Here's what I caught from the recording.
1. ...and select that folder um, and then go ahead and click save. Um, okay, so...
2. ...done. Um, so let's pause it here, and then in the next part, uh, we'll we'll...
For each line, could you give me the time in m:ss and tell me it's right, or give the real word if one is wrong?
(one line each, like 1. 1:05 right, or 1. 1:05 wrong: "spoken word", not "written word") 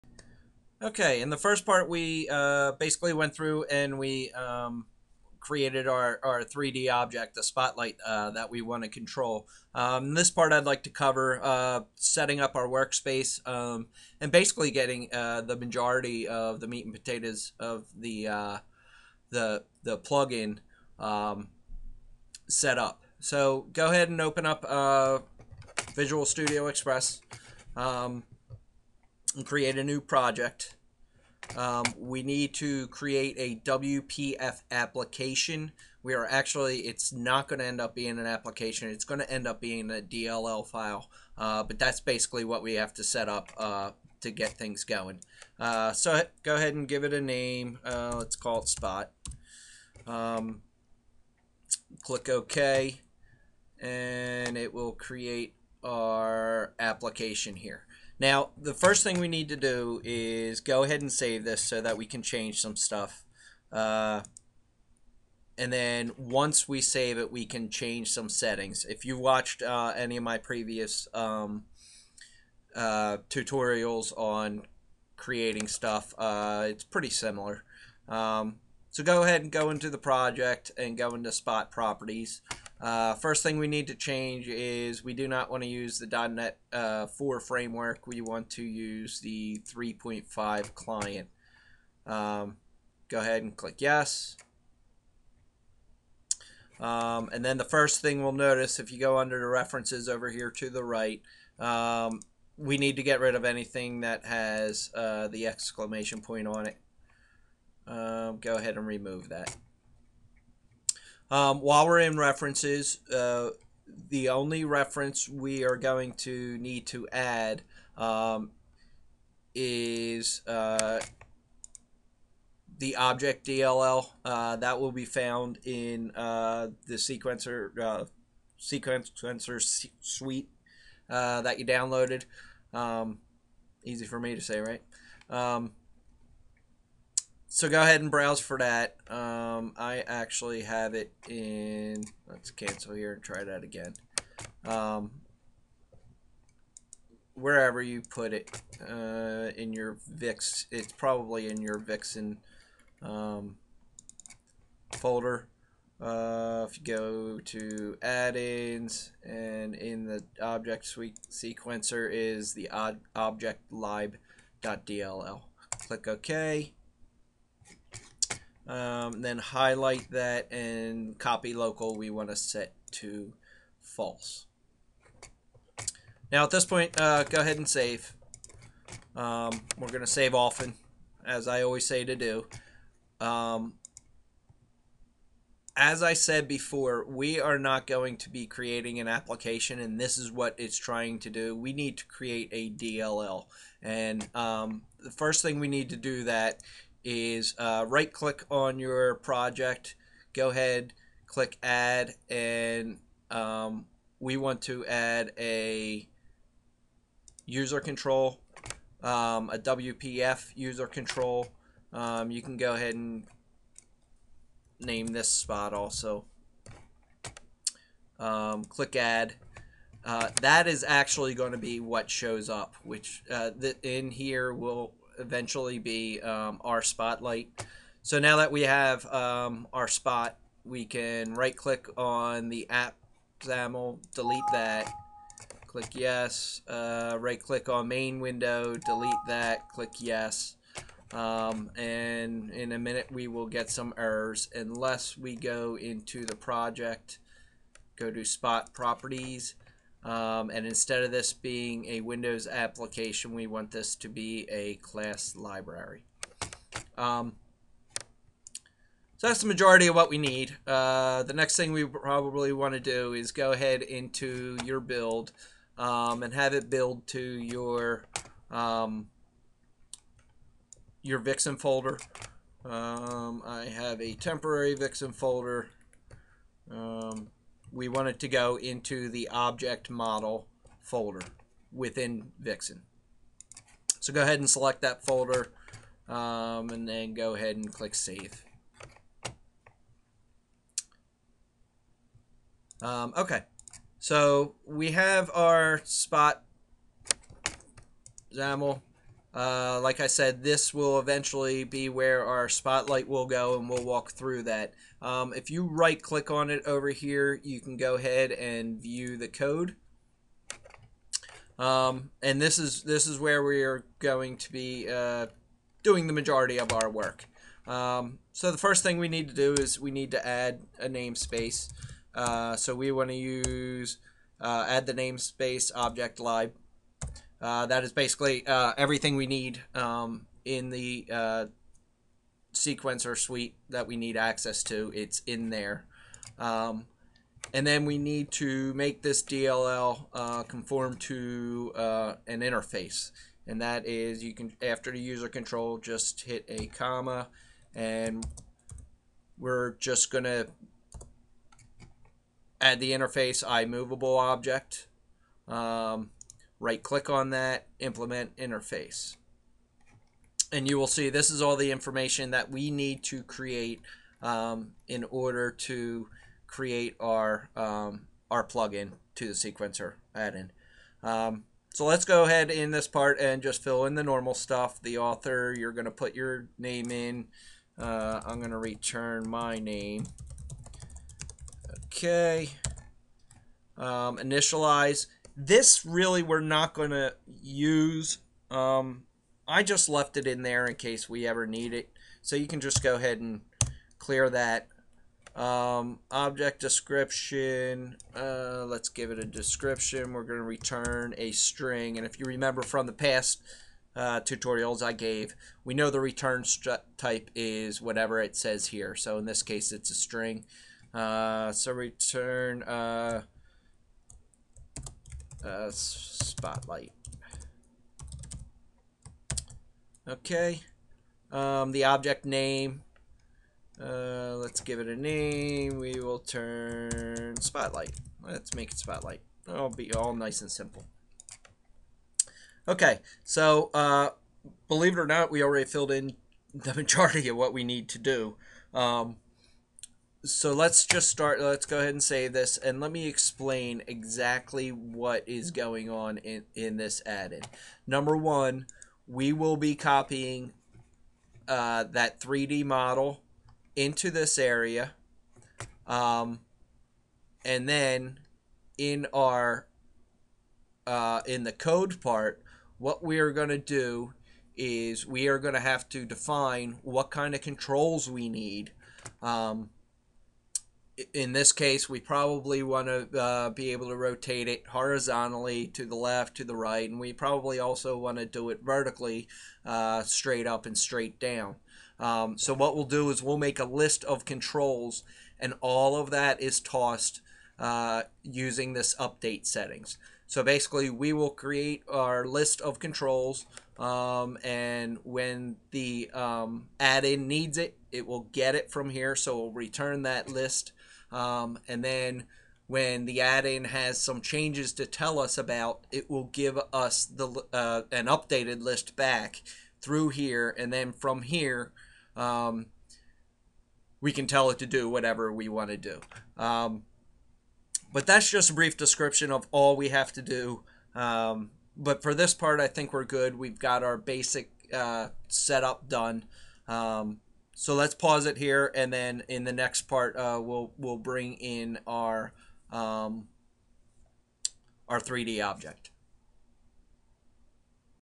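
1. 4:44 right
2. 8:45 right.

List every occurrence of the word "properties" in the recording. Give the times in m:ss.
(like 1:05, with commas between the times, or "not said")
1:21, 4:08.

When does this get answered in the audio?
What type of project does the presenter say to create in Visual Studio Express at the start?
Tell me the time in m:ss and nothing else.
0:33.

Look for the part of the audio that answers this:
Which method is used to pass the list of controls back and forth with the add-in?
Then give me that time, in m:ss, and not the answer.
8:08.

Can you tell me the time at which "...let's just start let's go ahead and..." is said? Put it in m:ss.
7:20.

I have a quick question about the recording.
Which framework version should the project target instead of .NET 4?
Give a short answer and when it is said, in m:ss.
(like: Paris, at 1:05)
3.5 client, at 1:29.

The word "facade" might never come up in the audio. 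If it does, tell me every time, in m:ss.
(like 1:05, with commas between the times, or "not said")
not said.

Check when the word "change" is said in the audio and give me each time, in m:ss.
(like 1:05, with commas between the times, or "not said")
1:02, 1:07, 1:23, 8:24.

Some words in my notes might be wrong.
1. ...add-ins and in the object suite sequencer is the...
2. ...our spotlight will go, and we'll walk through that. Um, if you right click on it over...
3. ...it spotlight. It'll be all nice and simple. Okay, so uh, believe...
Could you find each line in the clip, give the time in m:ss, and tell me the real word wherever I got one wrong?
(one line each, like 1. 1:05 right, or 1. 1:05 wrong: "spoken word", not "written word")
1. 2:38 right
2. 5:02 right
3. 7:08 right.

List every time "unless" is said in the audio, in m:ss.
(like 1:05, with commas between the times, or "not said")
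4:04.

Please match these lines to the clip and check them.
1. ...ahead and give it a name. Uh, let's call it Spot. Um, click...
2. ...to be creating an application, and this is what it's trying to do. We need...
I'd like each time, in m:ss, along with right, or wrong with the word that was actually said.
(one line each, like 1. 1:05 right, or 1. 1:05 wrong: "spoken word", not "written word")
1. 0:46 right
2. 3:08 right.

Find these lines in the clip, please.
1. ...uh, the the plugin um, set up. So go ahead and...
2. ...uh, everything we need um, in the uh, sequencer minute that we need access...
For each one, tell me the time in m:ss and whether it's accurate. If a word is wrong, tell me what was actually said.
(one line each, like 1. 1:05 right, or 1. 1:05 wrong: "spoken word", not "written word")
1. 0:18 right
2. 5:28 wrong: "suite", not "minute".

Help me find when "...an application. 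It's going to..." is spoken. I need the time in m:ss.
0:38.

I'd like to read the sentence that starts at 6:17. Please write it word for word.
Uh, I'm going to return my name.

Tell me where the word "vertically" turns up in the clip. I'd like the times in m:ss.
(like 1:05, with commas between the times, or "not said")
7:58.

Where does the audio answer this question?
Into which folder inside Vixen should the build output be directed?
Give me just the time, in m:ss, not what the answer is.
4:39.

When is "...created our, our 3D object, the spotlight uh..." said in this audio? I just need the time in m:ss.
0:05.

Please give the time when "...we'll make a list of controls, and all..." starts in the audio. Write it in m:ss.
8:03.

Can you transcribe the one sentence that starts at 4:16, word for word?
Um, so that's the majority of what we need.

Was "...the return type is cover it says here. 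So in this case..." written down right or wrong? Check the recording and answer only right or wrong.
wrong.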